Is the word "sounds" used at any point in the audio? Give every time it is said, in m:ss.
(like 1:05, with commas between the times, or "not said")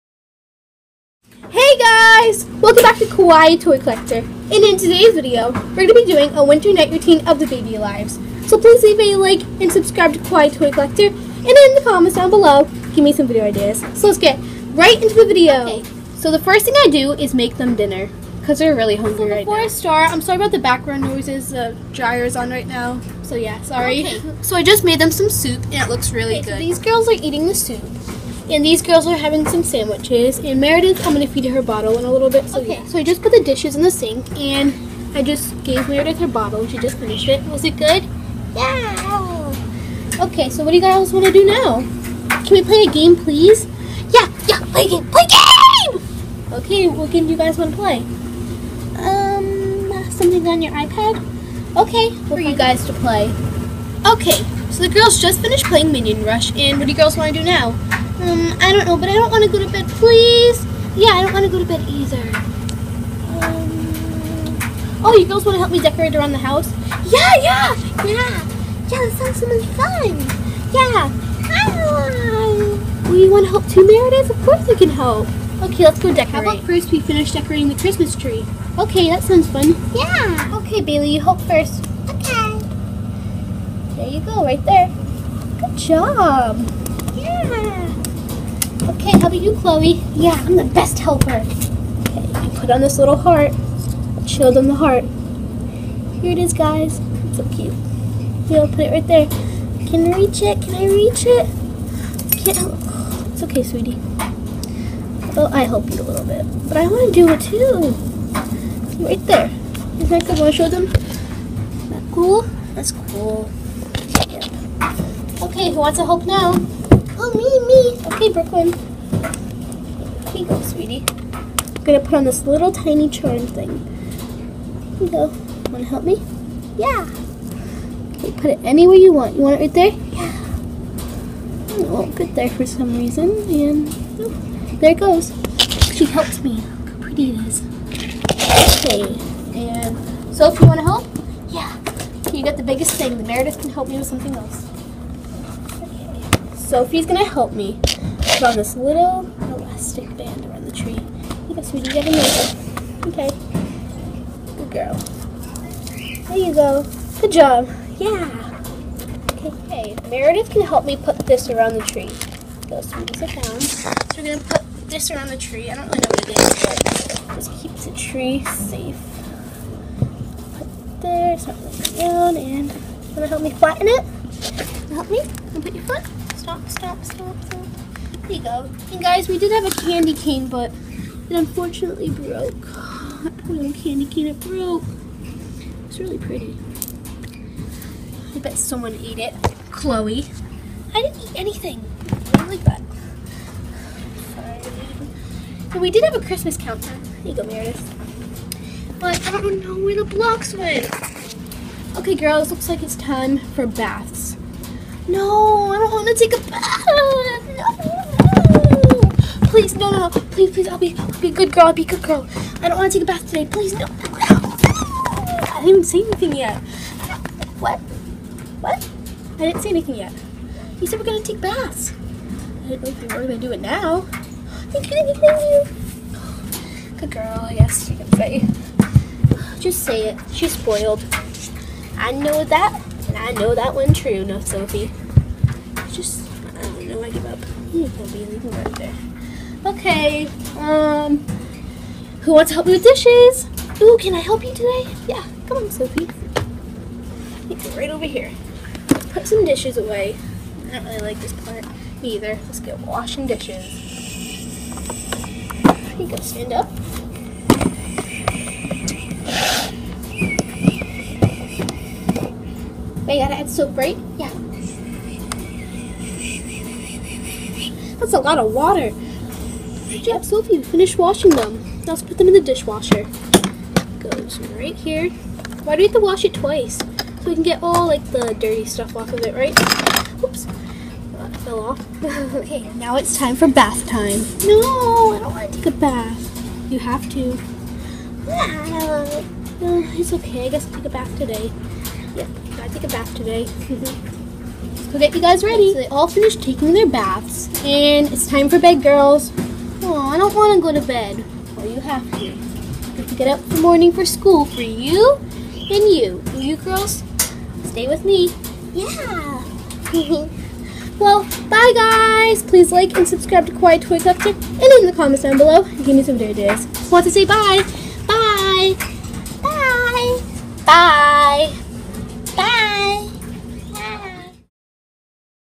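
1:09, 1:19.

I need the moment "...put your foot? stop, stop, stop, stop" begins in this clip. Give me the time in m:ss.
2:55.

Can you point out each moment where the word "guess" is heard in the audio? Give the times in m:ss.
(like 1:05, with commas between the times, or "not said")
2:31, 3:47, 4:50.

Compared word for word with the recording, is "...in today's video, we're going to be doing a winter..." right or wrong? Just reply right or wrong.
right.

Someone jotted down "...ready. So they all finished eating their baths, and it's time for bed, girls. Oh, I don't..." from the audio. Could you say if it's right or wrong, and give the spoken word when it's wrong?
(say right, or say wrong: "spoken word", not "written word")
wrong: "taking", not "eating".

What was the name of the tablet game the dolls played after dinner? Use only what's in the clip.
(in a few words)
Minion Rush.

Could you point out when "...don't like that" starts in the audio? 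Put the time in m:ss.
3:12.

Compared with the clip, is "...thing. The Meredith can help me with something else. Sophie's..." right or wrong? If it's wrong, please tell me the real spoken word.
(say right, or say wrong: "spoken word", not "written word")
right.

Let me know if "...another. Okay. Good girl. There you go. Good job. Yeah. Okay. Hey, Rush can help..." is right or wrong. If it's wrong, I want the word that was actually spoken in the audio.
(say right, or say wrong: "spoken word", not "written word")
wrong: "Meredith", not "Rush".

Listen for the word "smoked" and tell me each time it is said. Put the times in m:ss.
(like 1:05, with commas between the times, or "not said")
not said.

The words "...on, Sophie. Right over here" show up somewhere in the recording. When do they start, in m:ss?
4:05.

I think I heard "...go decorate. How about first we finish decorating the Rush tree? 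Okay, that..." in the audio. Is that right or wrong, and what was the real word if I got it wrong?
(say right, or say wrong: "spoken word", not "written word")
wrong: "Christmas", not "Rush".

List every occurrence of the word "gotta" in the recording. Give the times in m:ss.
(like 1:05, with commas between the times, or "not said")
4:23, 4:52.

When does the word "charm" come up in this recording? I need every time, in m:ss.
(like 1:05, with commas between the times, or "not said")
2:03.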